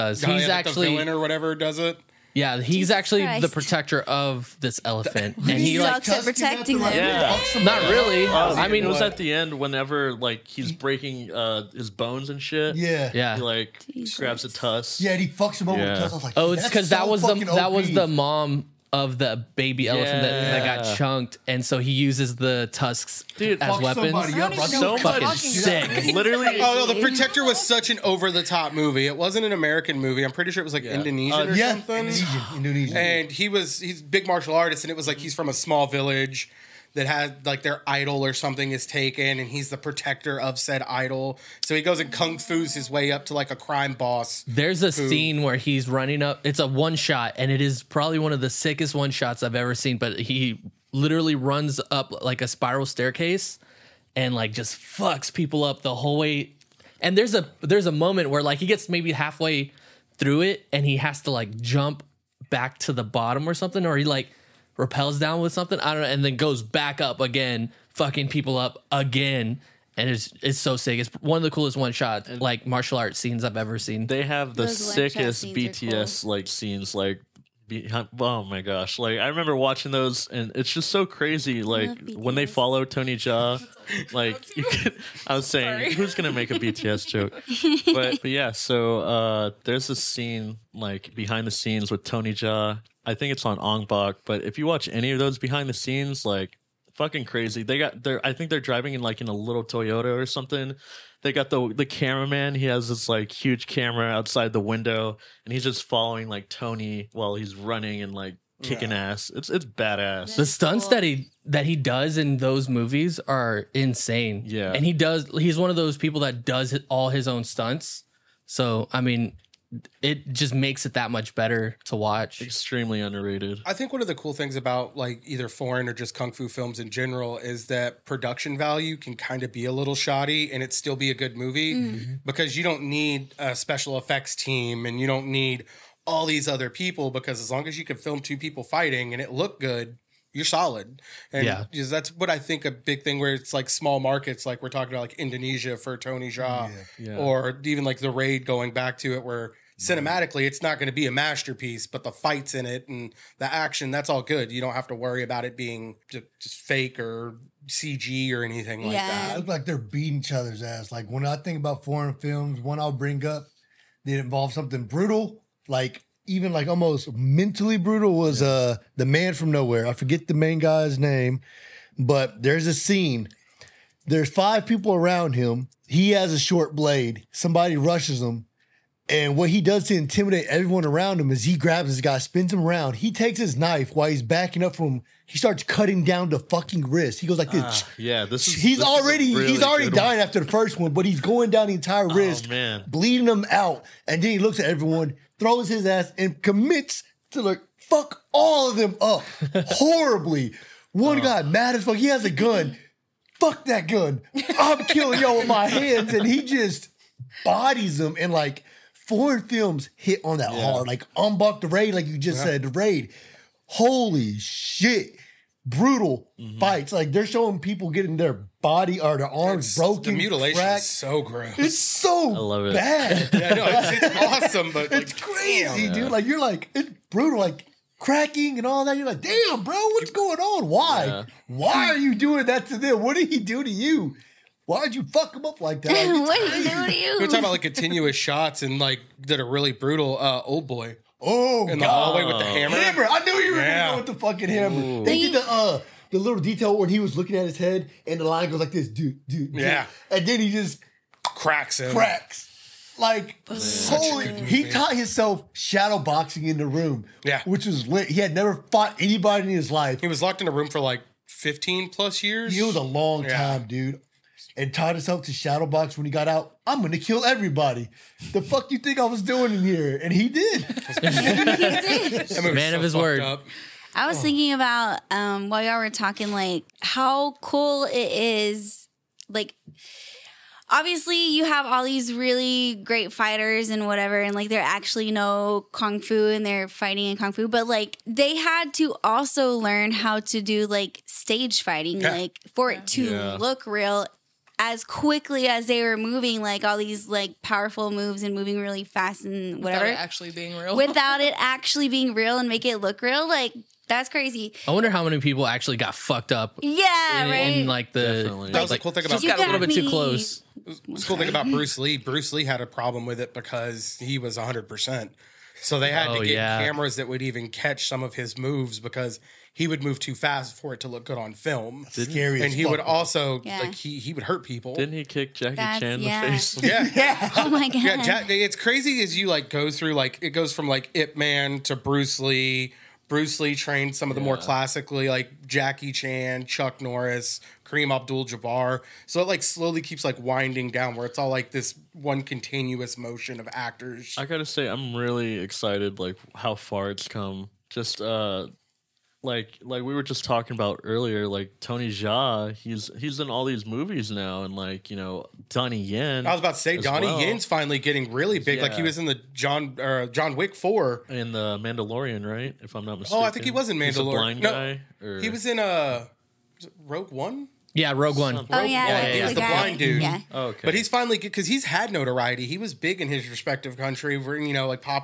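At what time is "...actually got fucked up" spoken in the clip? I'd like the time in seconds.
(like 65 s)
305 s.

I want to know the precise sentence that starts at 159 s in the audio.
It like they're beating each other's ass.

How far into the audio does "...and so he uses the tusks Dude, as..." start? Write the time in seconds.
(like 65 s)
21 s.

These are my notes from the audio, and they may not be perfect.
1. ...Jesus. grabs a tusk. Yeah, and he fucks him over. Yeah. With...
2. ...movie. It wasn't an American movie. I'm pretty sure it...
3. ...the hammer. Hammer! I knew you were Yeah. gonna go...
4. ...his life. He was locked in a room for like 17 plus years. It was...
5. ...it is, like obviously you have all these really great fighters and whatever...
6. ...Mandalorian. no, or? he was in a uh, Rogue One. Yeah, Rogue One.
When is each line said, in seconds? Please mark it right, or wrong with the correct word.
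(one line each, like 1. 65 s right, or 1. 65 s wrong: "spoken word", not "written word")
1. 13 s right
2. 28 s right
3. 242 s right
4. 259 s wrong: "15", not "17"
5. 277 s right
6. 363 s right.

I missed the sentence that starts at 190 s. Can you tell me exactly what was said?
after the first one, but he's going down the entire oh, wrist, oh, bleeding him out.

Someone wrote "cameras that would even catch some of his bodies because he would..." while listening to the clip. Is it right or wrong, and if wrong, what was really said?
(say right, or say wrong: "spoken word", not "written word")
wrong: "moves", not "bodies".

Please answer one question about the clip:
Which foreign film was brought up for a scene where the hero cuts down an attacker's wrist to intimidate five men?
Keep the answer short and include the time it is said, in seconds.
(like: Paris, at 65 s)
The Man from Nowhere, at 168 s.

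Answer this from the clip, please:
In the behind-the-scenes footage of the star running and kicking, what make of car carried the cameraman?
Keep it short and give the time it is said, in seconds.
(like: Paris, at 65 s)
Toyota, at 99 s.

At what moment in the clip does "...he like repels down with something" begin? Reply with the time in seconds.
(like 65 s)
63 s.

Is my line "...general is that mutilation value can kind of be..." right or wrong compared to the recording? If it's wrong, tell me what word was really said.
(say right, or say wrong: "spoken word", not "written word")
wrong: "production", not "mutilation".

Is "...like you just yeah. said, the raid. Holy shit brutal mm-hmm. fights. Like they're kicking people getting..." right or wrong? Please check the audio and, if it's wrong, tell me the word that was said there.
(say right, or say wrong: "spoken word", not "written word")
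wrong: "showing", not "kicking".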